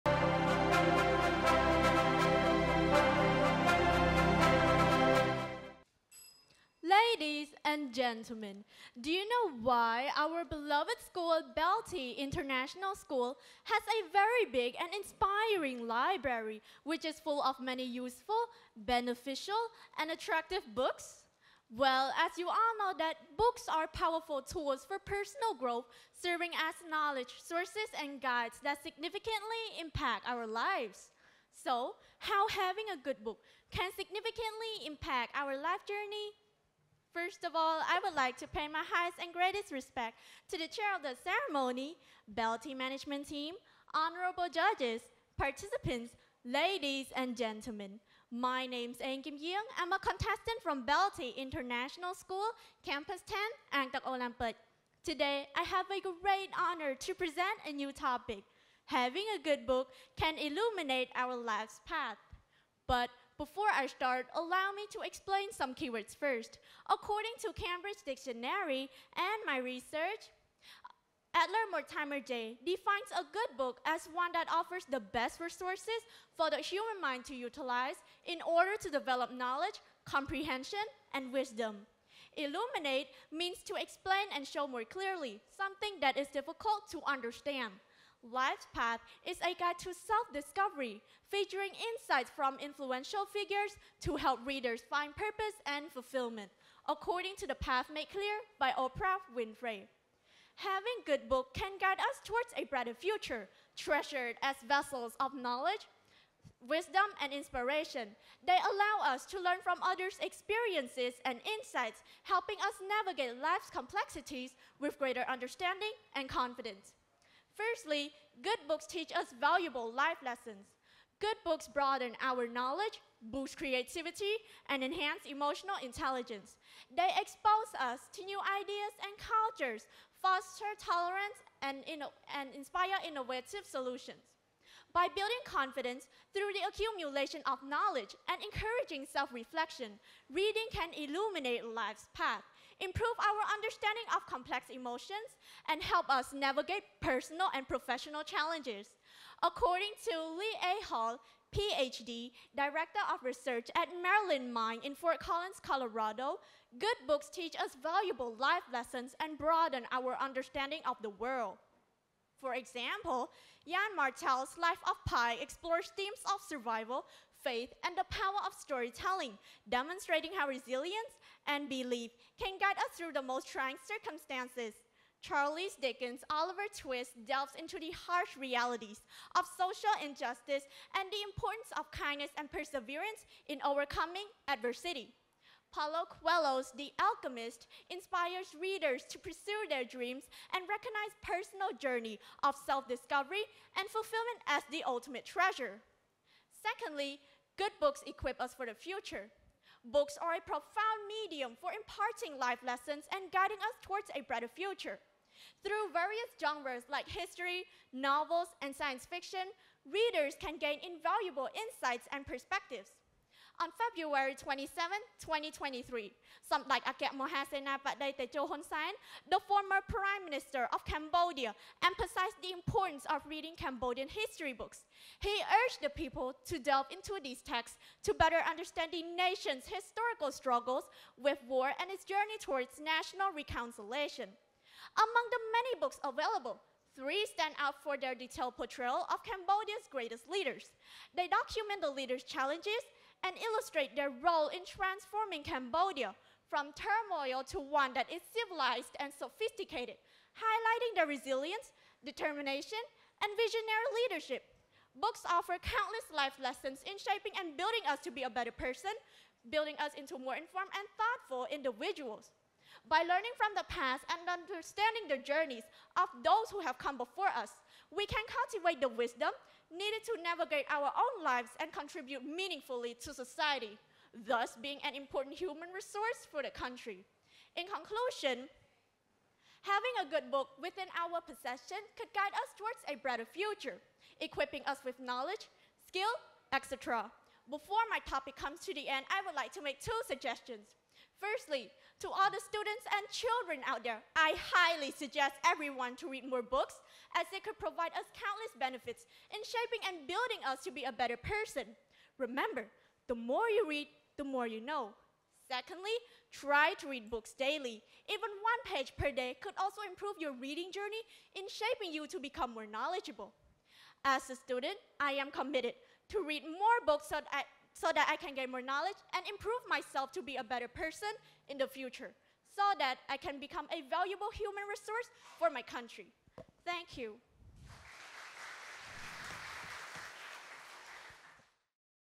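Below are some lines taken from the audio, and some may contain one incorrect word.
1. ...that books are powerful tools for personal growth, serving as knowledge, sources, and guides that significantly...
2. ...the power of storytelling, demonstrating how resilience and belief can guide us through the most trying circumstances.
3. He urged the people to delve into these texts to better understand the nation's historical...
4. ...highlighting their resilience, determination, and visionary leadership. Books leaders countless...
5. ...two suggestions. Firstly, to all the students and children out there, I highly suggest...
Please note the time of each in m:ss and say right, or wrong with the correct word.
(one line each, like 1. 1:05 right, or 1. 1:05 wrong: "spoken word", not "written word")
1. 0:22 right
2. 2:47 right
3. 3:45 right
4. 4:10 wrong: "offer", not "leaders"
5. 4:49 right.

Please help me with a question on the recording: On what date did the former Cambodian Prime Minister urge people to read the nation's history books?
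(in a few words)
February 27, 2023.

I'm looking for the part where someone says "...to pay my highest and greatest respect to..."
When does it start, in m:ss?
0:38.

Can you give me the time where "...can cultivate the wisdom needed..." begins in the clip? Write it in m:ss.
4:28.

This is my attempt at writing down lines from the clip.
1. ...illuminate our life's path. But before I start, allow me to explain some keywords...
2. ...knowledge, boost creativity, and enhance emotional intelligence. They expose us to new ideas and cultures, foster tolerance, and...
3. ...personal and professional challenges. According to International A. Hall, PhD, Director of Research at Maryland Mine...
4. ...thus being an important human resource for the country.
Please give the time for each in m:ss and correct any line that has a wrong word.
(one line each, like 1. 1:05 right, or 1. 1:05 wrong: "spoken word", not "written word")
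1. 1:00 right
2. 2:02 right
3. 2:27 wrong: "Lee", not "International"
4. 4:34 right.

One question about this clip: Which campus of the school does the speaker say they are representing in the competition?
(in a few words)
Campus 10.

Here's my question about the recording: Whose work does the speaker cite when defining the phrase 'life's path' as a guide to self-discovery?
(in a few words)
Oprah Winfrey.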